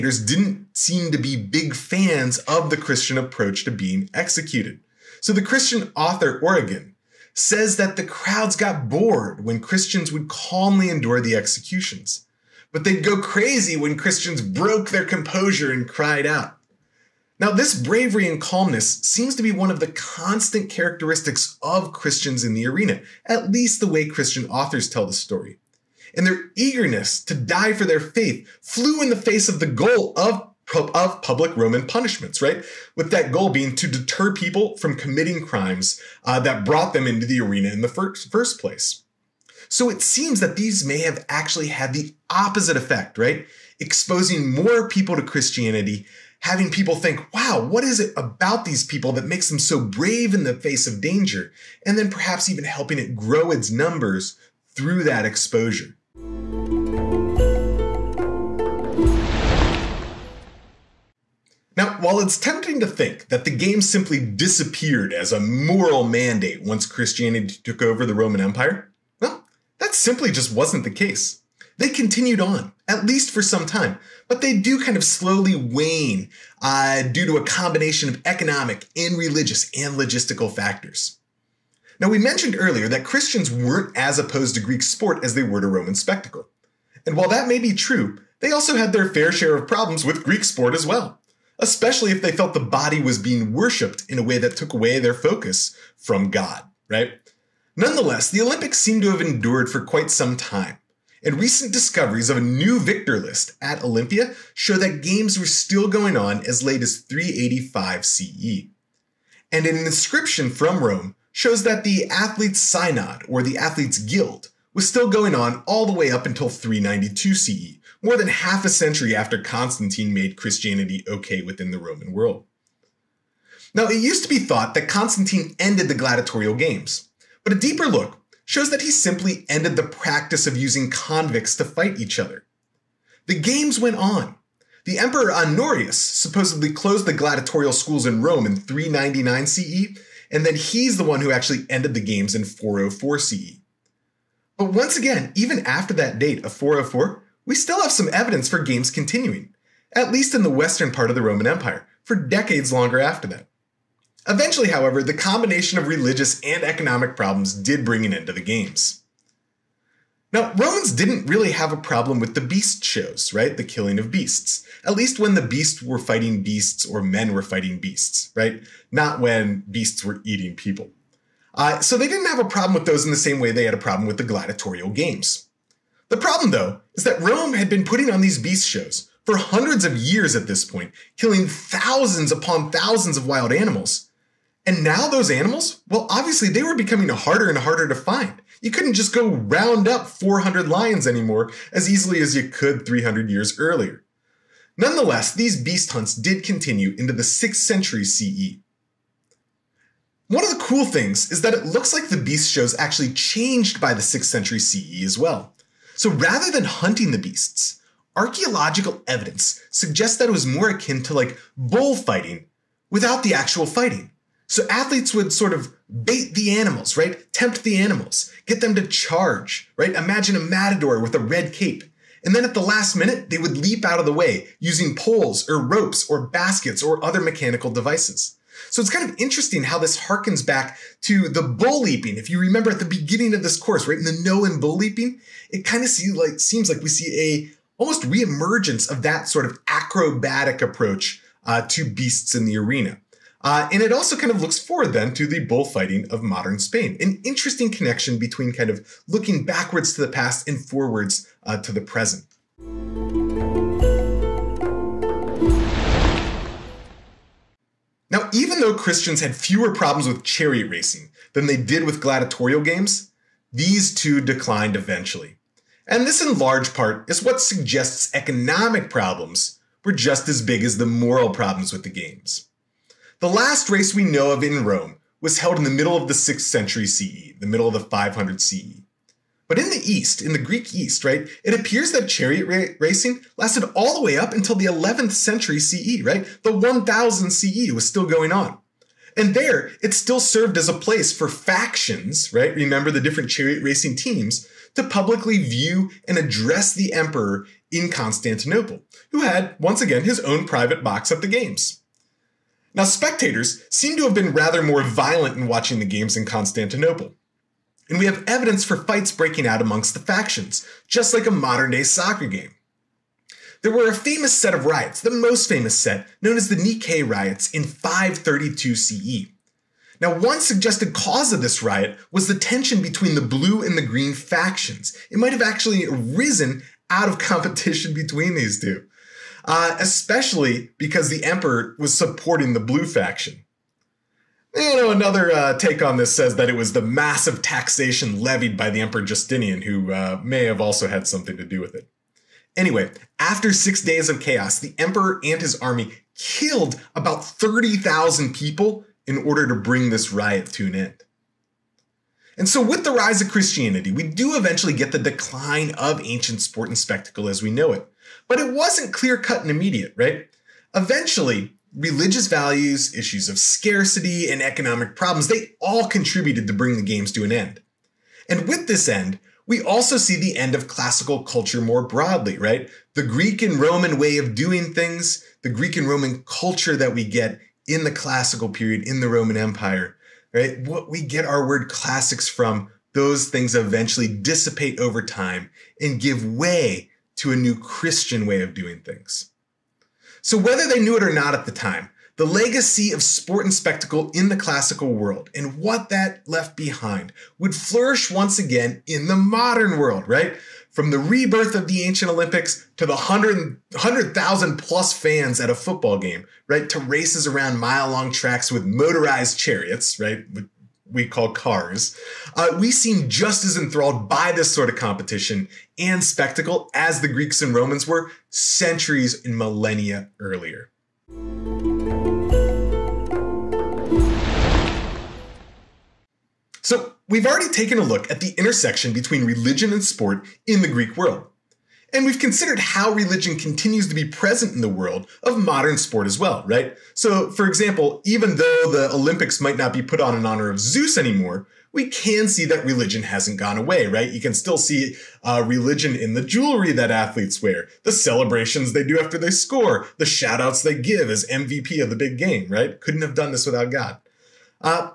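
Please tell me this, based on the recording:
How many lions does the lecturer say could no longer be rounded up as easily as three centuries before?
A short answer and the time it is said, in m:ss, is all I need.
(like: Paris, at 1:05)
400, at 3:10.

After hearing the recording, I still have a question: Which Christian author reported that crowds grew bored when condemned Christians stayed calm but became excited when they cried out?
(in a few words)
Origen.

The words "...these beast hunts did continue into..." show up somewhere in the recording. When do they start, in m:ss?
3:15.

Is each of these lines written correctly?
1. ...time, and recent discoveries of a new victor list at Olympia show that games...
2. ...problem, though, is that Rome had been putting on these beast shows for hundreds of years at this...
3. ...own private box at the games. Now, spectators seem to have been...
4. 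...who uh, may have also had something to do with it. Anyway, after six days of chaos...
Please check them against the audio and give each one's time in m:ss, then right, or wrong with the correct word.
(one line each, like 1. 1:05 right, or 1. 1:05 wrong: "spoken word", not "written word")
1. 1:40 right
2. 2:56 right
3. 5:00 right
4. 5:39 right.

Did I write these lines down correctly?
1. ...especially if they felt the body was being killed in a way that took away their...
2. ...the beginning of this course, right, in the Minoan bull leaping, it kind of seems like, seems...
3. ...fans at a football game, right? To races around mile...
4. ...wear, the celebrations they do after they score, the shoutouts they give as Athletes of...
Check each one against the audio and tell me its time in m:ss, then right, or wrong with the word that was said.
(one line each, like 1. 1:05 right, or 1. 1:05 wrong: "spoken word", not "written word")
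1. 1:31 wrong: "worshipped", not "killed"
2. 3:52 right
3. 6:44 right
4. 7:27 wrong: "MVP", not "Athletes".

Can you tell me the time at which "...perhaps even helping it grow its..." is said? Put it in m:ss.
0:52.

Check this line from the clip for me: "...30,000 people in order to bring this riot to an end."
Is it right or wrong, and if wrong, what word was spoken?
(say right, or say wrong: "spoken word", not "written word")
right.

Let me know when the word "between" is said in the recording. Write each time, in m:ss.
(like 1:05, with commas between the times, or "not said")
4:08, 5:22, 5:27, 7:08.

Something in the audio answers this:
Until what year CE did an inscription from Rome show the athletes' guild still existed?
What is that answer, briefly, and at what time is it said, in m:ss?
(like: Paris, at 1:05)
392 CE, at 1:56.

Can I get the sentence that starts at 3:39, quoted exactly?
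Imagine a matador with a red cape.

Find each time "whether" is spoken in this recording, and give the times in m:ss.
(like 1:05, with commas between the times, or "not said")
6:30.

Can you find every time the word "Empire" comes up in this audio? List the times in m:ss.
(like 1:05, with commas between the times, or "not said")
1:08, 2:31, 6:19.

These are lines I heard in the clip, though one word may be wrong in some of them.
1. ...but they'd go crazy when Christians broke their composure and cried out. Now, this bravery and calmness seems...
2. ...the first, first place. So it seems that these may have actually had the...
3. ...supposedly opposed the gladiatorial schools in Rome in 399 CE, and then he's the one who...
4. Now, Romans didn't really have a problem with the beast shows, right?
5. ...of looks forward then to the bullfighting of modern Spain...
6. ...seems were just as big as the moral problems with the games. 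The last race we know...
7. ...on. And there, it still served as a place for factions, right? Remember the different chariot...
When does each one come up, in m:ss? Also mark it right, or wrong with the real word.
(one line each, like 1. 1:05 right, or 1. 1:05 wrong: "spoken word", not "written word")
1. 0:12 right
2. 0:37 right
3. 2:15 wrong: "closed", not "opposed"
4. 2:40 right
5. 4:04 right
6. 4:28 wrong: "problems", not "seems"
7. 4:48 right.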